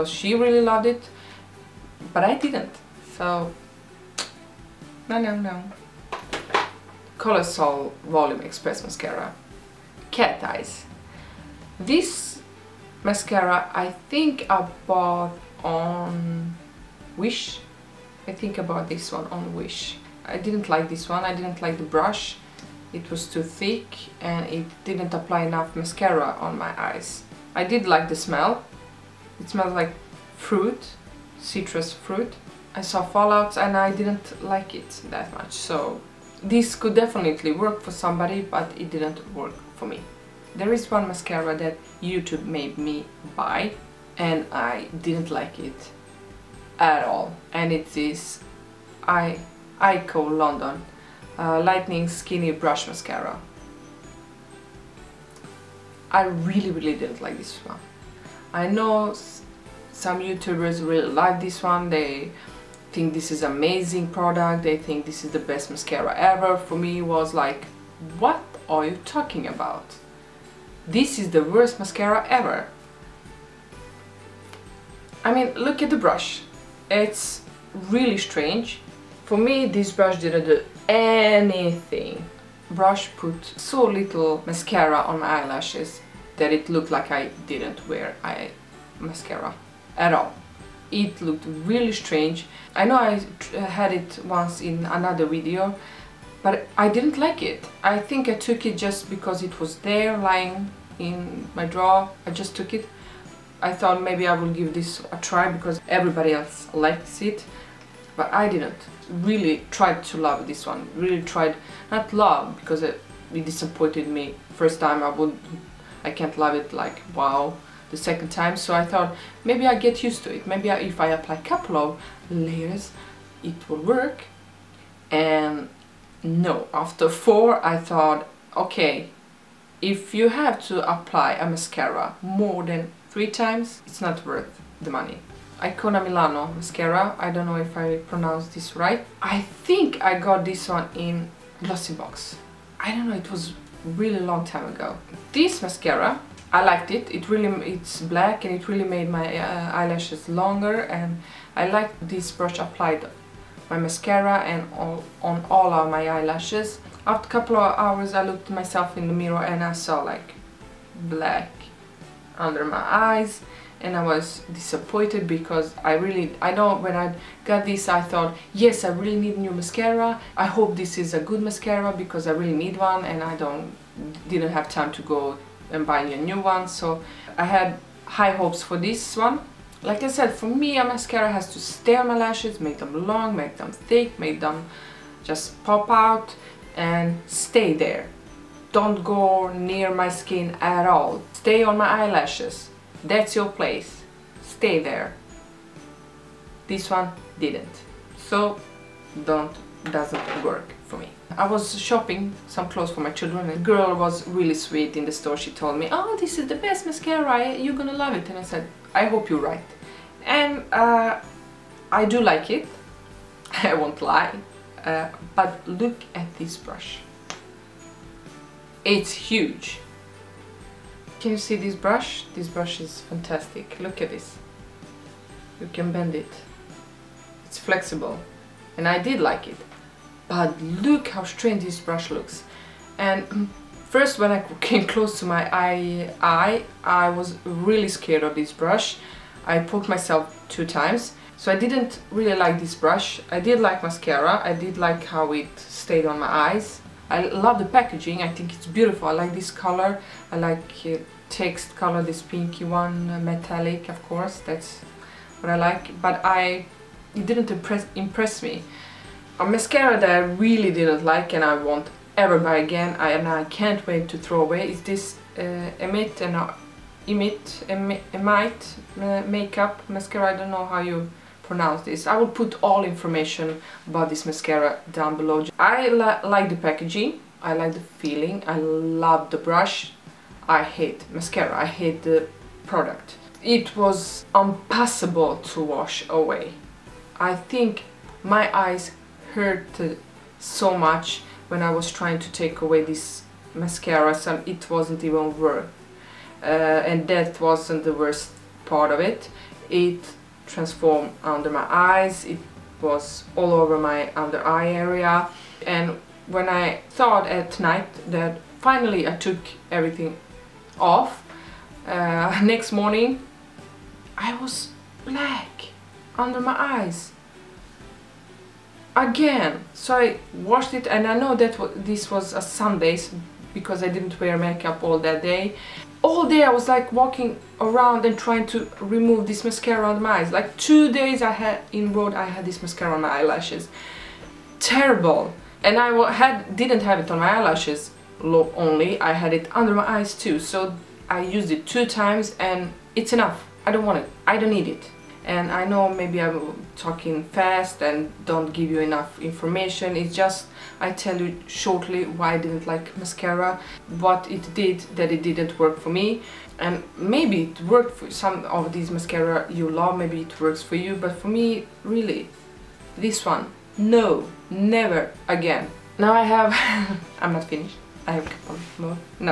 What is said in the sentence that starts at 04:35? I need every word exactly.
I li like the packaging, I like the feeling, I love the brush.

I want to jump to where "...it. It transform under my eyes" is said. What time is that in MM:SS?
04:59.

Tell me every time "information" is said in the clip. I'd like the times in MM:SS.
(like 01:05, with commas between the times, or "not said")
04:32, 05:49.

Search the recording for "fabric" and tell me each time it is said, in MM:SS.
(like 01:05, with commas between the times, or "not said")
not said.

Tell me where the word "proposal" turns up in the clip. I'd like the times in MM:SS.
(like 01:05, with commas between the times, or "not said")
not said.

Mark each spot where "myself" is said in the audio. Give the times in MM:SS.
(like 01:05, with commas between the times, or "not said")
02:38, 03:59.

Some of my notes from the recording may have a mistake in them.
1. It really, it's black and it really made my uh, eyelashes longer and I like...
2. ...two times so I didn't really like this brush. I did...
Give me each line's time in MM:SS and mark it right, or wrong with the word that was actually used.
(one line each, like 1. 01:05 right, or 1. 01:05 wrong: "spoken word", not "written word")
1. 02:27 right
2. 04:00 right.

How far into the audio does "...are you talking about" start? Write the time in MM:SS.
01:08.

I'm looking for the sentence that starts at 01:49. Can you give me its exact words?
Really tried to love this one.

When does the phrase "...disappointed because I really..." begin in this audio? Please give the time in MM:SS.
02:44.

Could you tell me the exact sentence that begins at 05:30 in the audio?
Like two days I had in road I had this mascara on my eyelashes.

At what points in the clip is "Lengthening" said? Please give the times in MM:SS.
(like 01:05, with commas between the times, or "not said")
00:51.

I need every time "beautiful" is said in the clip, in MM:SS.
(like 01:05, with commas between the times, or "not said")
04:08.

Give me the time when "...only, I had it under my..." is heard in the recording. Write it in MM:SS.
05:38.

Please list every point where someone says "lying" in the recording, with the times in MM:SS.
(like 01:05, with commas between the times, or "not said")
01:40.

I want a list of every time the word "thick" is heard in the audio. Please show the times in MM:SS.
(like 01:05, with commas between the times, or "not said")
00:23, 03:03.